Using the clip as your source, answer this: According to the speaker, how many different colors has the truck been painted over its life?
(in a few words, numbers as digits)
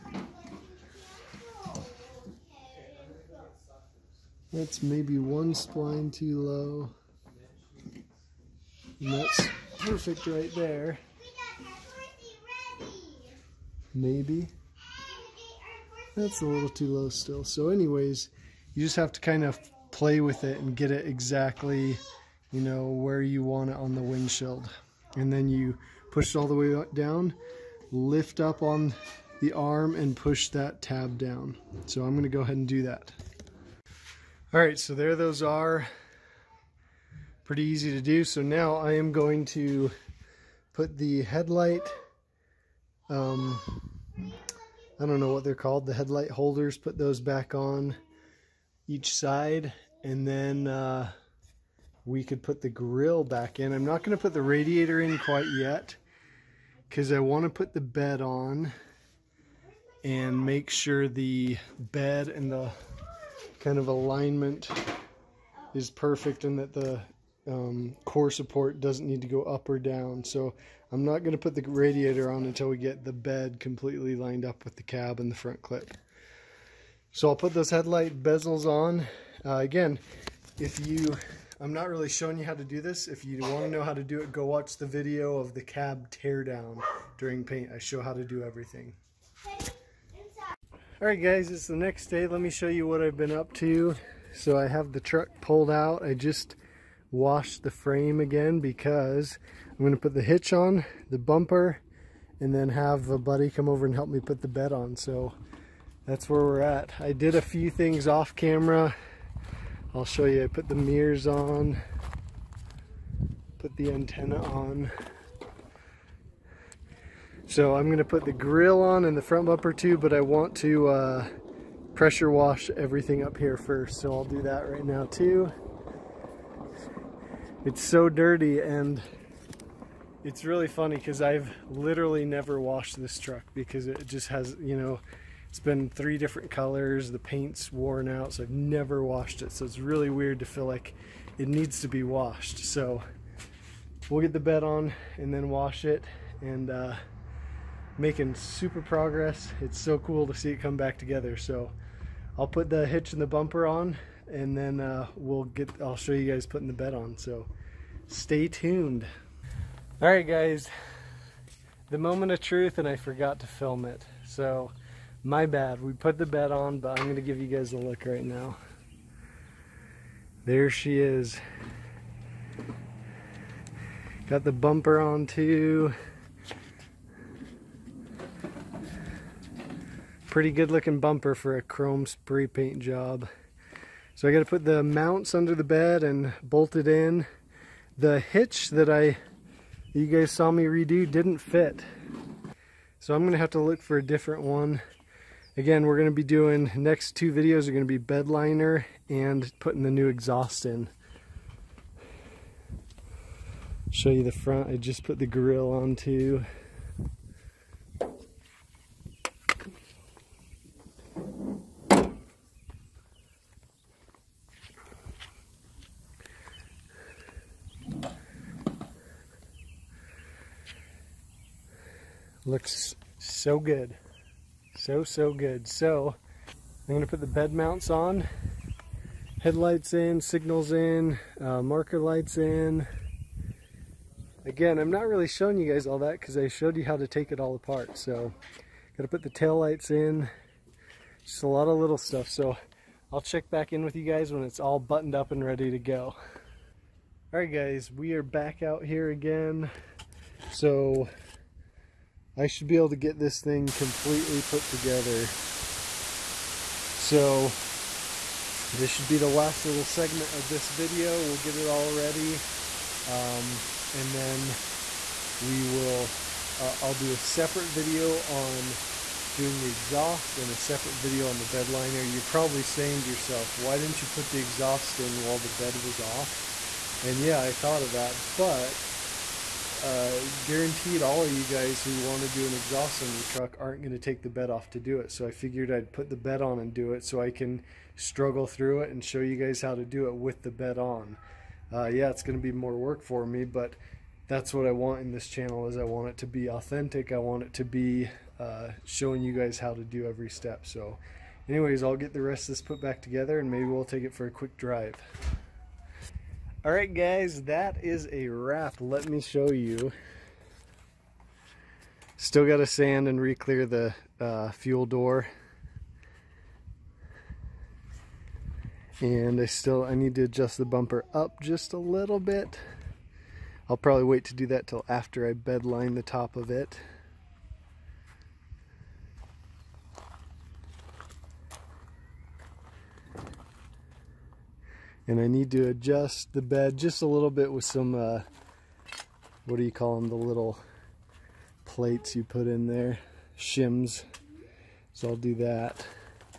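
3.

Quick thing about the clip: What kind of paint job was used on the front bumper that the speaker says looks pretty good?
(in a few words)
Chrome spray paint.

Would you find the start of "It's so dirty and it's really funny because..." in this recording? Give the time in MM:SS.
02:07.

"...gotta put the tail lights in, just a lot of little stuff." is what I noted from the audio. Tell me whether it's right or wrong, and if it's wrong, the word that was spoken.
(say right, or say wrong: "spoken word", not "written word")
right.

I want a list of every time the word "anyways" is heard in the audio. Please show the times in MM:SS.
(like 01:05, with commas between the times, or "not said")
00:17, 05:01.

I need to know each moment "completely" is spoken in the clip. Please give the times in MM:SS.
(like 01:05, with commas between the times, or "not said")
01:13, 04:13.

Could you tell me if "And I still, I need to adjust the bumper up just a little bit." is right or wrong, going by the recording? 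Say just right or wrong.
right.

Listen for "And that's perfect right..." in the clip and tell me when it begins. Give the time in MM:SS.
00:08.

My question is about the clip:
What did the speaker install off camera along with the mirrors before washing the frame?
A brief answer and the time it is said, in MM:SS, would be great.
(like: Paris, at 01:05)
Antenna, at 01:53.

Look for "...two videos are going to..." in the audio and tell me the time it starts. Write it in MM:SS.
03:17.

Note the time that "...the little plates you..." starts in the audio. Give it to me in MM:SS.
05:40.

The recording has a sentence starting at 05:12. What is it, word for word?
Still got to sand and re-clear the uh, fuel door.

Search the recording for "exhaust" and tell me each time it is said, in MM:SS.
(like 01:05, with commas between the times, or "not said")
03:20, 04:29, 04:34, 04:42.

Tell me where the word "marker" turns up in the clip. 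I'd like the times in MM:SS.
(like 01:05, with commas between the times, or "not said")
03:51.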